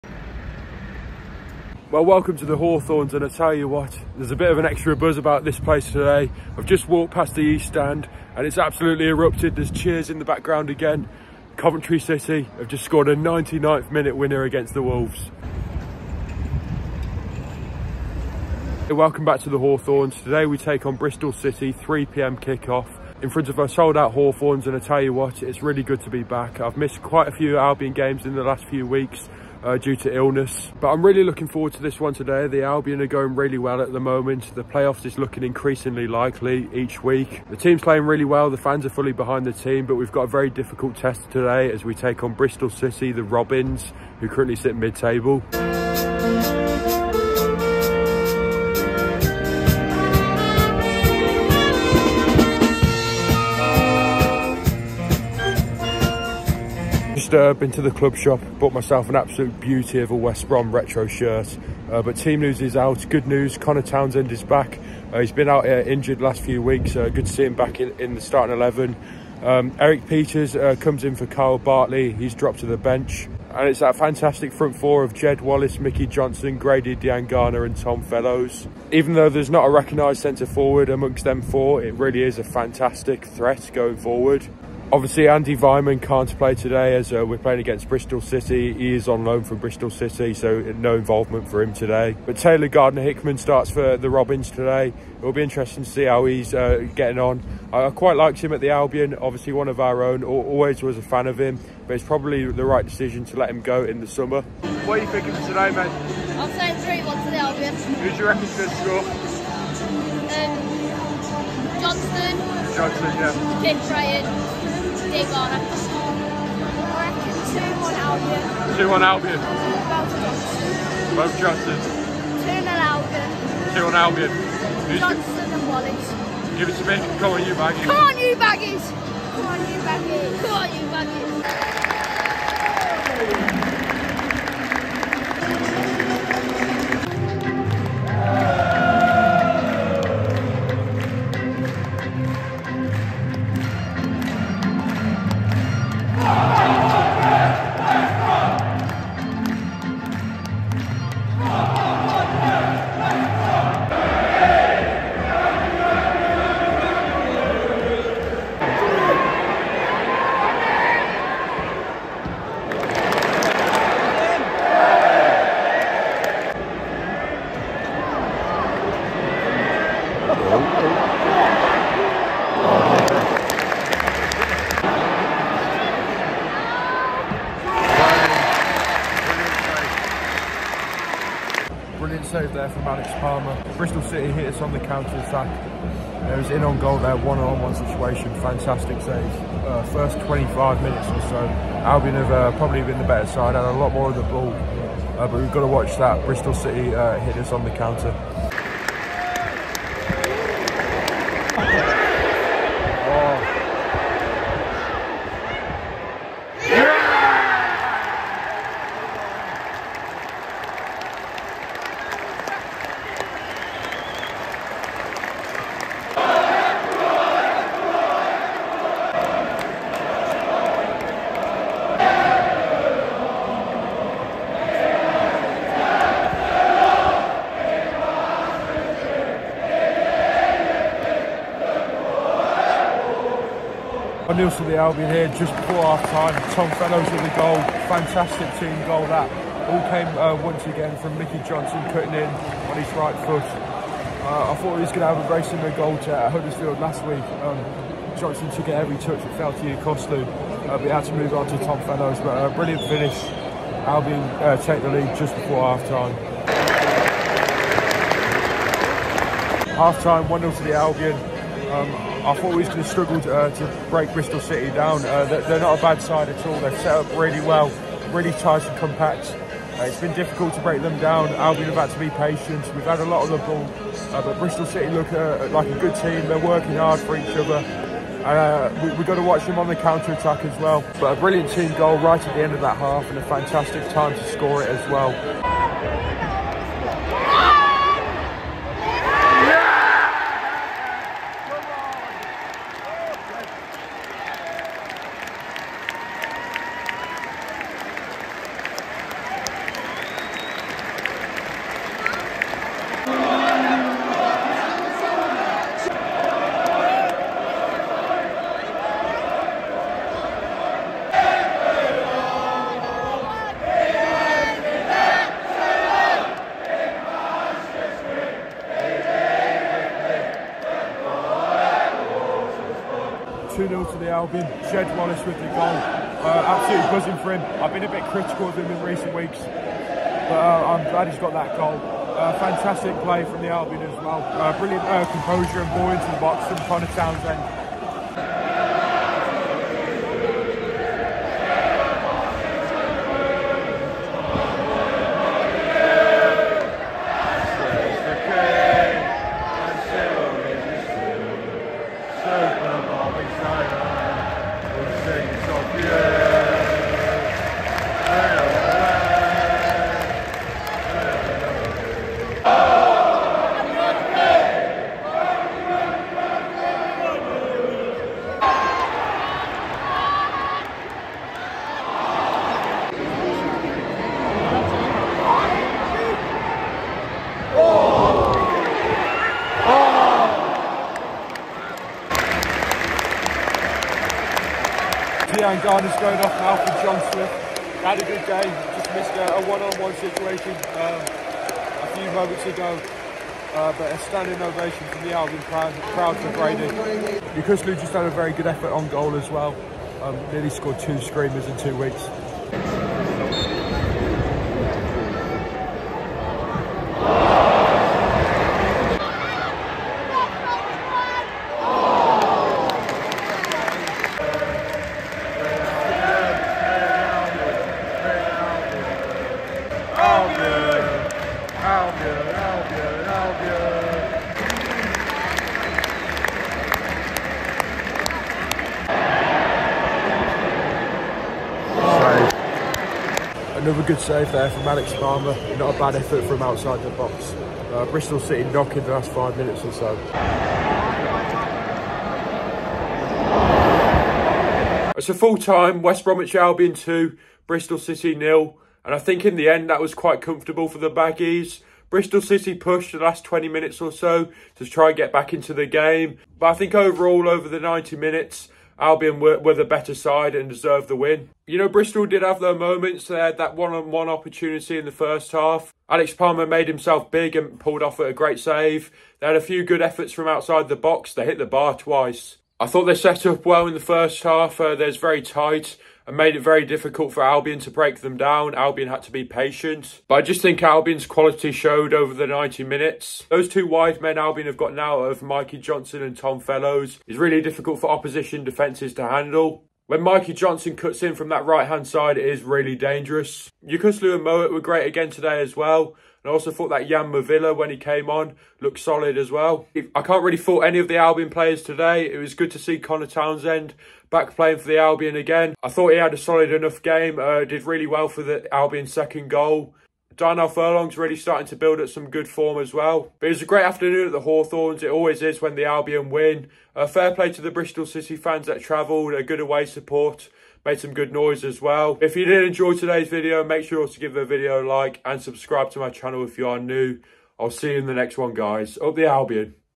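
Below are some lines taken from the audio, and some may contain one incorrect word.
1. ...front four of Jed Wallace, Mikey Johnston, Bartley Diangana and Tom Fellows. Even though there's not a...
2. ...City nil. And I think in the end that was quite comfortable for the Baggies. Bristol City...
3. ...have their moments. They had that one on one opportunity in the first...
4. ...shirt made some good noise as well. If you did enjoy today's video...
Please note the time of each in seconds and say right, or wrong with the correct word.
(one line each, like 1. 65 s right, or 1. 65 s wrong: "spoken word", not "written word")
1. 74 s wrong: "Grady", not "Bartley"
2. 447 s right
3. 462 s right
4. 519 s wrong: "support", not "shirt".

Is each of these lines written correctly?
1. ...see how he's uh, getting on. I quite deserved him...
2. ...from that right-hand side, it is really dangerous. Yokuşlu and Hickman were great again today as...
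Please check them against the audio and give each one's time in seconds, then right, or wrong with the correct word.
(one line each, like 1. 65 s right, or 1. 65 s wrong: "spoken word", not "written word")
1. 95 s wrong: "liked", not "deserved"
2. 491 s wrong: "Mowatt", not "Hickman".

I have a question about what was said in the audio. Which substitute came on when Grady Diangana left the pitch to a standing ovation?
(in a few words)
John Swift.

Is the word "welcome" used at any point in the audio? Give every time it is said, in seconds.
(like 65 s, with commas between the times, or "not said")
2 s, 18 s.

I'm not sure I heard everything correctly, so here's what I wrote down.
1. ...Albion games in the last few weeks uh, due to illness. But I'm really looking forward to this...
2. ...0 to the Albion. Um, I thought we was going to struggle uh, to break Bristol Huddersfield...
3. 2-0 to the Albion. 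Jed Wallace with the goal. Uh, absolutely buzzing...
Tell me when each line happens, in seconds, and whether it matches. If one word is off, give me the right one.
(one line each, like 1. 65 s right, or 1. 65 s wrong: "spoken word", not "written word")
1. 27 s right
2. 260 s wrong: "City", not "Huddersfield"
3. 323 s right.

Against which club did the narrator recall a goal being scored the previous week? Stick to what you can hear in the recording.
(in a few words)
Huddersfield.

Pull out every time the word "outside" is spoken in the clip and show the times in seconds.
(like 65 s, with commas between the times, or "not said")
436 s, 470 s.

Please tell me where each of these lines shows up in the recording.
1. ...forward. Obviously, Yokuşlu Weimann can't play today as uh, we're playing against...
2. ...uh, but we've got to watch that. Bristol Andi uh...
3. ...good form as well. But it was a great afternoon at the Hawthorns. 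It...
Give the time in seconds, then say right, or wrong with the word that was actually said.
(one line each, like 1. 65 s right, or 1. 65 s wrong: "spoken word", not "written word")
1. 83 s wrong: "Andi", not "Yokuşlu"
2. 195 s wrong: "City", not "Andi"
3. 512 s right.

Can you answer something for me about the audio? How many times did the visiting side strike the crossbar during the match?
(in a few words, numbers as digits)
2.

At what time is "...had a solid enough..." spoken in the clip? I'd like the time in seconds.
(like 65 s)
505 s.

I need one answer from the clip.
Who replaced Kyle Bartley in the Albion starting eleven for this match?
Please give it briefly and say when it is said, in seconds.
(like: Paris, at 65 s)
Erik Pieters, at 69 s.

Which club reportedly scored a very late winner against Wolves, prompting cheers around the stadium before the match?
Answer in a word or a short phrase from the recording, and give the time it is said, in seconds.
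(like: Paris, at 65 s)
Coventry City, at 11 s.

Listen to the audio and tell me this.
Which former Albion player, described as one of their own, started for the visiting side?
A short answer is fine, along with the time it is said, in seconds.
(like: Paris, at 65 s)
Taylor Gardner Hickman, at 92 s.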